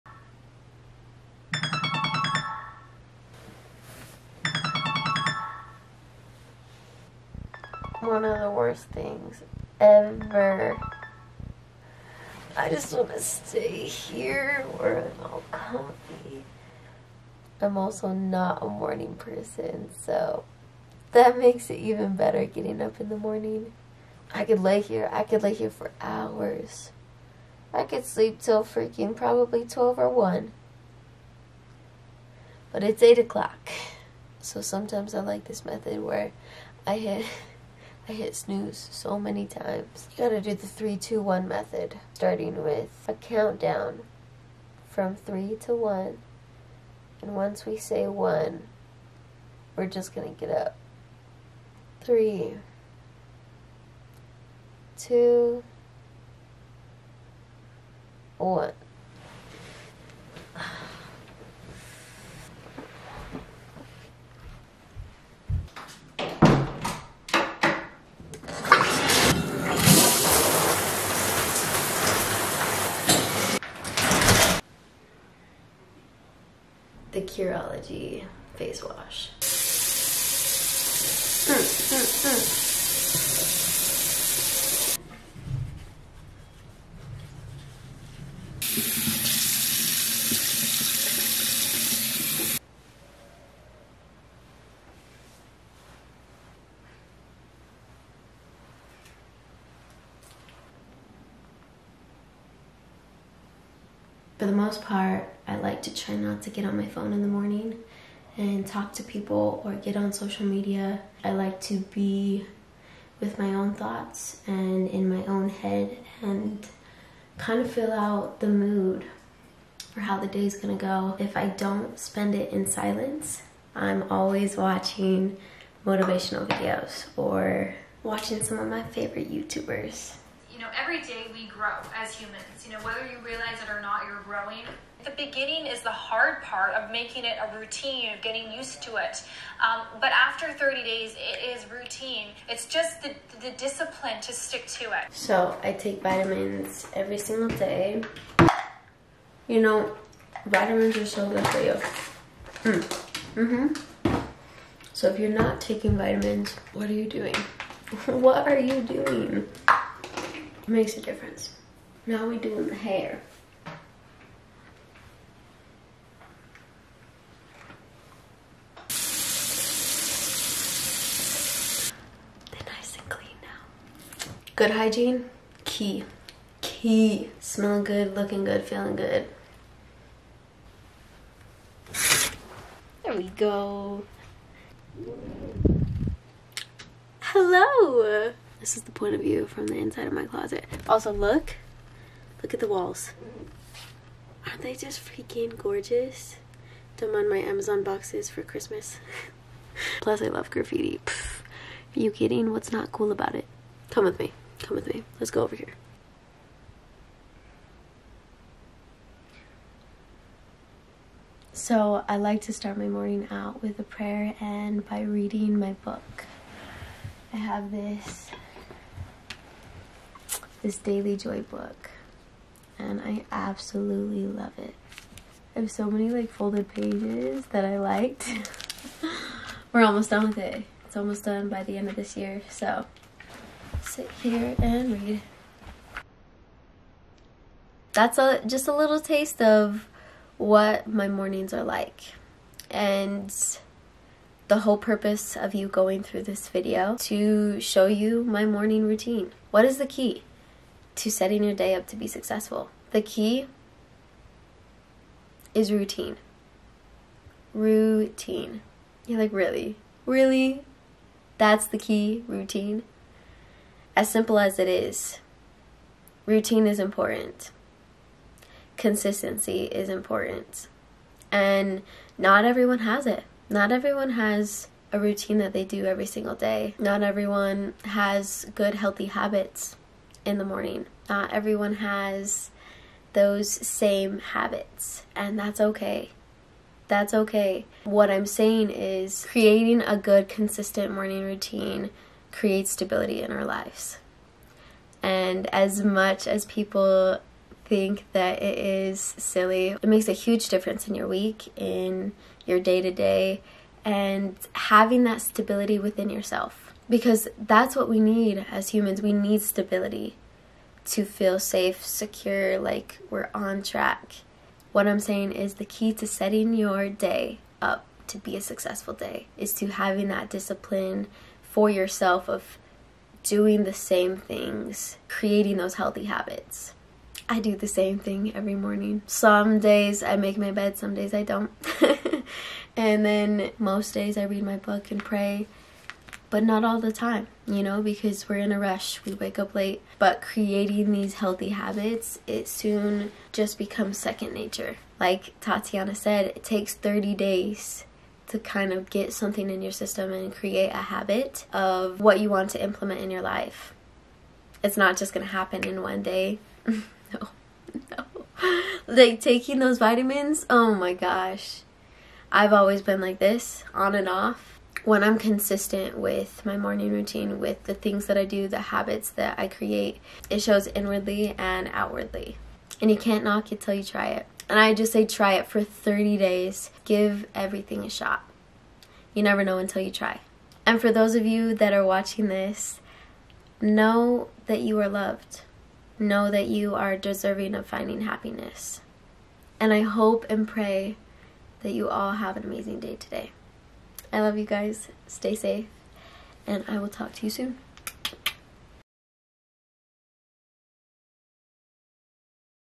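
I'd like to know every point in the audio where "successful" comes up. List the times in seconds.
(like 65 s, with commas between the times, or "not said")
252 s, 318 s.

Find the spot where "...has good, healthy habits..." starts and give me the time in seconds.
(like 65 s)
277 s.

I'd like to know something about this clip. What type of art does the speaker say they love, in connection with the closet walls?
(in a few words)
Graffiti.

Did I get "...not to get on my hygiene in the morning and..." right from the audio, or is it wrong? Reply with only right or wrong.
wrong.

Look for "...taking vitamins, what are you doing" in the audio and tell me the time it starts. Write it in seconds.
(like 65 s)
155 s.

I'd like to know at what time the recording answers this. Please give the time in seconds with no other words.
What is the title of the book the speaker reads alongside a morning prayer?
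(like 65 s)
220 s.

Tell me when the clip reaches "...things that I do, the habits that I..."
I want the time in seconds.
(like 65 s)
367 s.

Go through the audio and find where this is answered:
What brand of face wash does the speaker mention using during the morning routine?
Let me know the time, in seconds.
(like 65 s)
77 s.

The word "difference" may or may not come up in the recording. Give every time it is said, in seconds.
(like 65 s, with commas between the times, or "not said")
161 s, 300 s.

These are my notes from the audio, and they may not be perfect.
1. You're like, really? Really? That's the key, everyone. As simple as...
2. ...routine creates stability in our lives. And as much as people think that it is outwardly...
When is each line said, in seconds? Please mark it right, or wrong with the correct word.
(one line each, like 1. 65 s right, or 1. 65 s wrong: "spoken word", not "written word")
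1. 259 s wrong: "routine", not "everyone"
2. 291 s wrong: "silly", not "outwardly".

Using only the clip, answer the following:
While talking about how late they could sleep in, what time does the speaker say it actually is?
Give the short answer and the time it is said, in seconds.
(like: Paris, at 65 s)
8 o'clock, at 33 s.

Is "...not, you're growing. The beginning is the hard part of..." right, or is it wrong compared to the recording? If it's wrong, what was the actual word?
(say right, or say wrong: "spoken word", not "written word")
right.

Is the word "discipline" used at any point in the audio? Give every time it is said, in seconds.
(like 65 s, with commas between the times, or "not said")
143 s, 320 s.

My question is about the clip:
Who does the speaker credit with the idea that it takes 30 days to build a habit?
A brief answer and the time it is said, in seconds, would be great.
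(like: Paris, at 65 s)
Tatiana, at 345 s.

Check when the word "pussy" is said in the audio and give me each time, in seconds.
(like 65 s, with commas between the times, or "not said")
not said.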